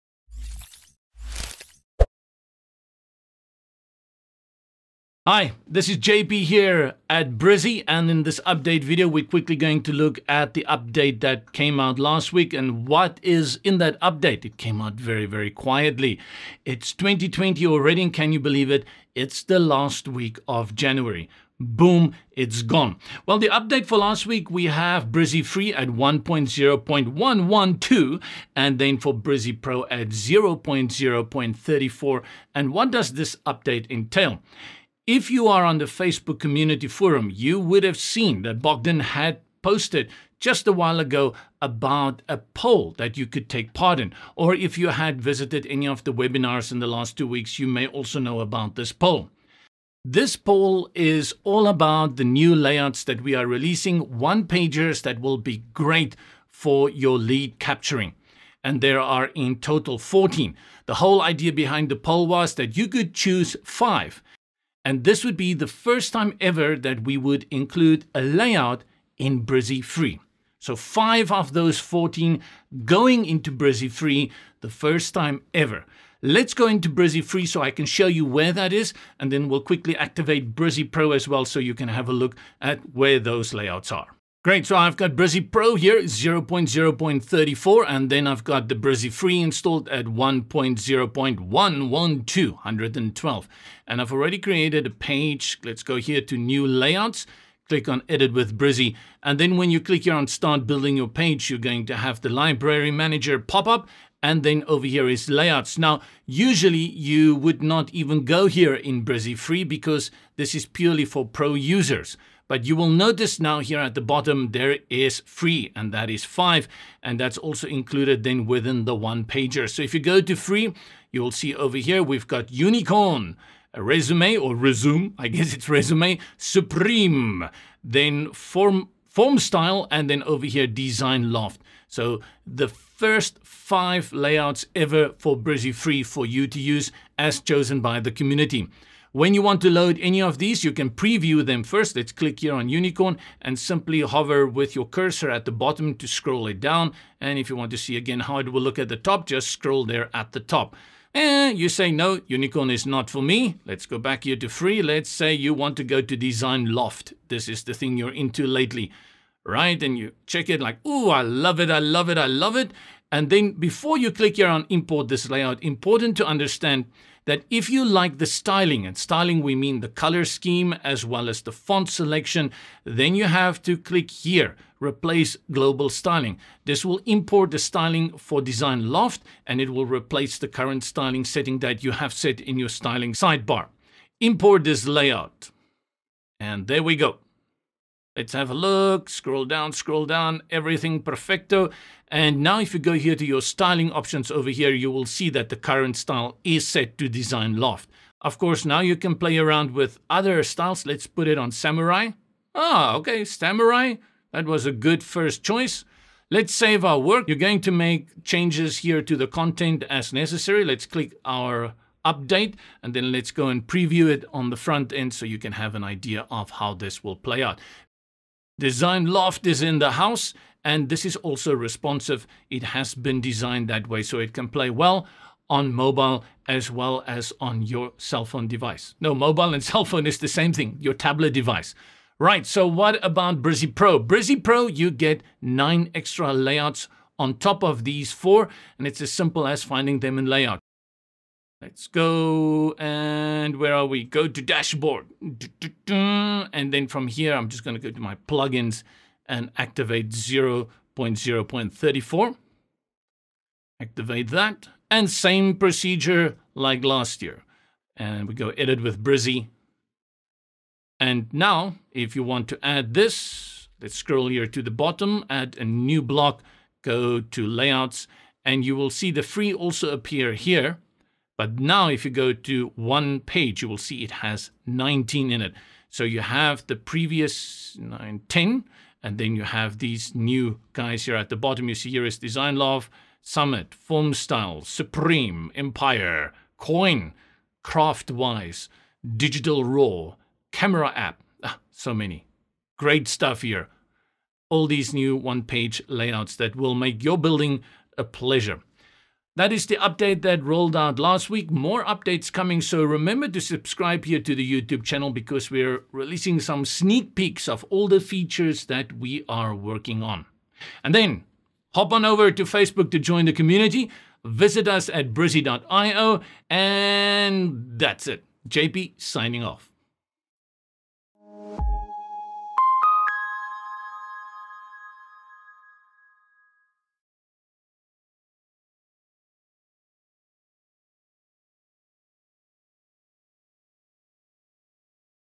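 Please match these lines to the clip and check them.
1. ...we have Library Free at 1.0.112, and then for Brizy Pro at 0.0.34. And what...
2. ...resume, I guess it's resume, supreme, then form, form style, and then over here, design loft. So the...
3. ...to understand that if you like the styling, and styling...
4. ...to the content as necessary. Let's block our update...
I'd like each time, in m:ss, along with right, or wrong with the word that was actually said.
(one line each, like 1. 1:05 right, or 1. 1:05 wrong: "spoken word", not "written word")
1. 0:24 wrong: "Brizy", not "Library"
2. 2:04 right
3. 2:46 right
4. 3:29 wrong: "click", not "block".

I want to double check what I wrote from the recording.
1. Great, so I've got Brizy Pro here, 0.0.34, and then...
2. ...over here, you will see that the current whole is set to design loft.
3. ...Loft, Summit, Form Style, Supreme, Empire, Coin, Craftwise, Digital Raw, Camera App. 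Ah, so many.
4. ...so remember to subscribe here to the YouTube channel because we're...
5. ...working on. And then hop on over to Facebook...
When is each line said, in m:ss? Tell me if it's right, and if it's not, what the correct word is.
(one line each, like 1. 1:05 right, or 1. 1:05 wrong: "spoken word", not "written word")
1. 1:24 right
2. 3:14 wrong: "style", not "whole"
3. 4:42 right
4. 5:02 right
5. 5:09 right.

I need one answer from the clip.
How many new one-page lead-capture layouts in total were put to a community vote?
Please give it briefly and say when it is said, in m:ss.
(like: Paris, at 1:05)
14, at 0:58.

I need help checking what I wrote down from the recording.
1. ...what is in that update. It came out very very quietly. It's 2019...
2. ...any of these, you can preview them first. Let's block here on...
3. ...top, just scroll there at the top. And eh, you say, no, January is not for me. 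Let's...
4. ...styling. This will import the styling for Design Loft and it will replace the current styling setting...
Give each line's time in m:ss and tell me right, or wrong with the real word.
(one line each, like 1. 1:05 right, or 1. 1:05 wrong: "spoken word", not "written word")
1. 0:12 wrong: "2020", not "2019"
2. 2:19 wrong: "click", not "block"
3. 2:28 wrong: "Unicorn", not "January"
4. 2:55 right.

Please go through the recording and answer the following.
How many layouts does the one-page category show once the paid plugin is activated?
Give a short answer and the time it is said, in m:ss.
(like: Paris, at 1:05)
19, at 4:33.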